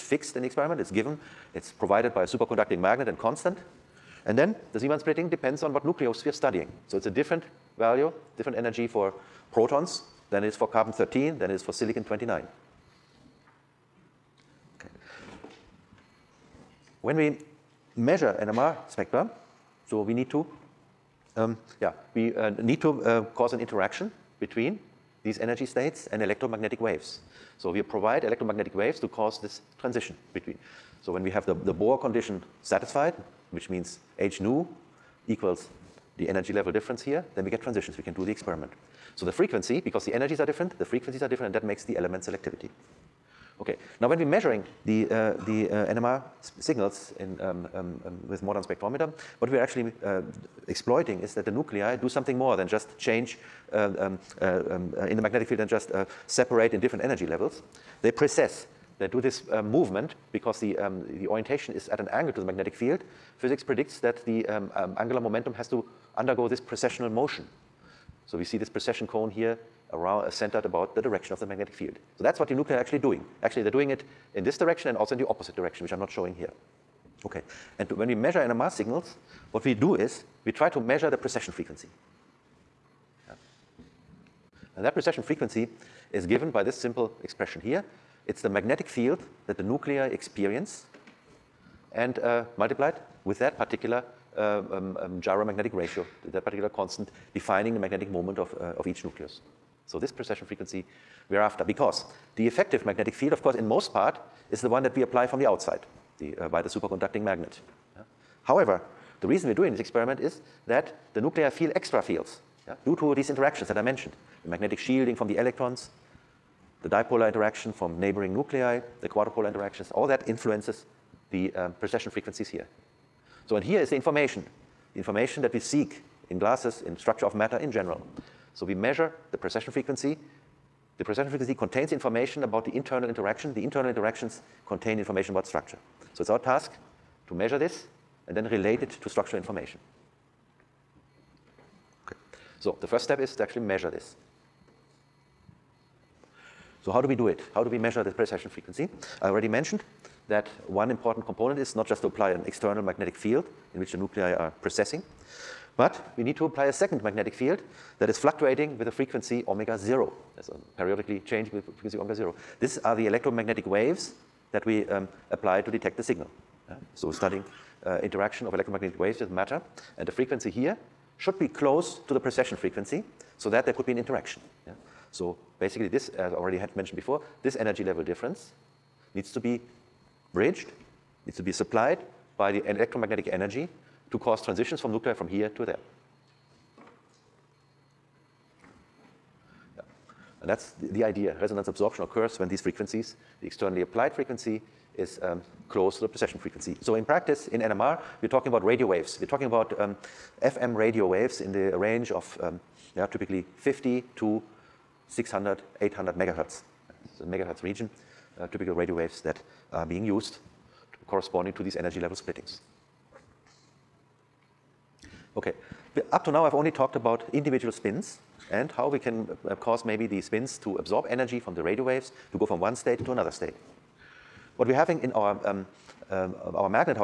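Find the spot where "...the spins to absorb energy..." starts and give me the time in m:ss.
3:40.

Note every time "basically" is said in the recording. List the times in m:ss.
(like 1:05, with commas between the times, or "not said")
2:55.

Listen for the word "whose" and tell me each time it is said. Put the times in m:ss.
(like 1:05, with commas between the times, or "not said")
not said.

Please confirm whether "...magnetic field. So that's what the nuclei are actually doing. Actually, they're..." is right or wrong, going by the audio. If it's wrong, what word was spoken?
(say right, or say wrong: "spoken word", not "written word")
right.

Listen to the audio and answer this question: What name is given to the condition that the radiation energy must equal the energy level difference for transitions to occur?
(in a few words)
Bohr condition.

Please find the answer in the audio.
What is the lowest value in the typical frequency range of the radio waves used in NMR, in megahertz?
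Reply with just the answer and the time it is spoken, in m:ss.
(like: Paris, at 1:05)
50, at 3:23.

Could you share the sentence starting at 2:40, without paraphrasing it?
That's um, periodically changing with frequency omega zero.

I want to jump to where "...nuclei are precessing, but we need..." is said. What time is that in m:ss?
2:33.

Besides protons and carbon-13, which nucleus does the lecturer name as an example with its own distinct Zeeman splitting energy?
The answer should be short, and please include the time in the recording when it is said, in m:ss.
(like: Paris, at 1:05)
silicon-29, at 0:11.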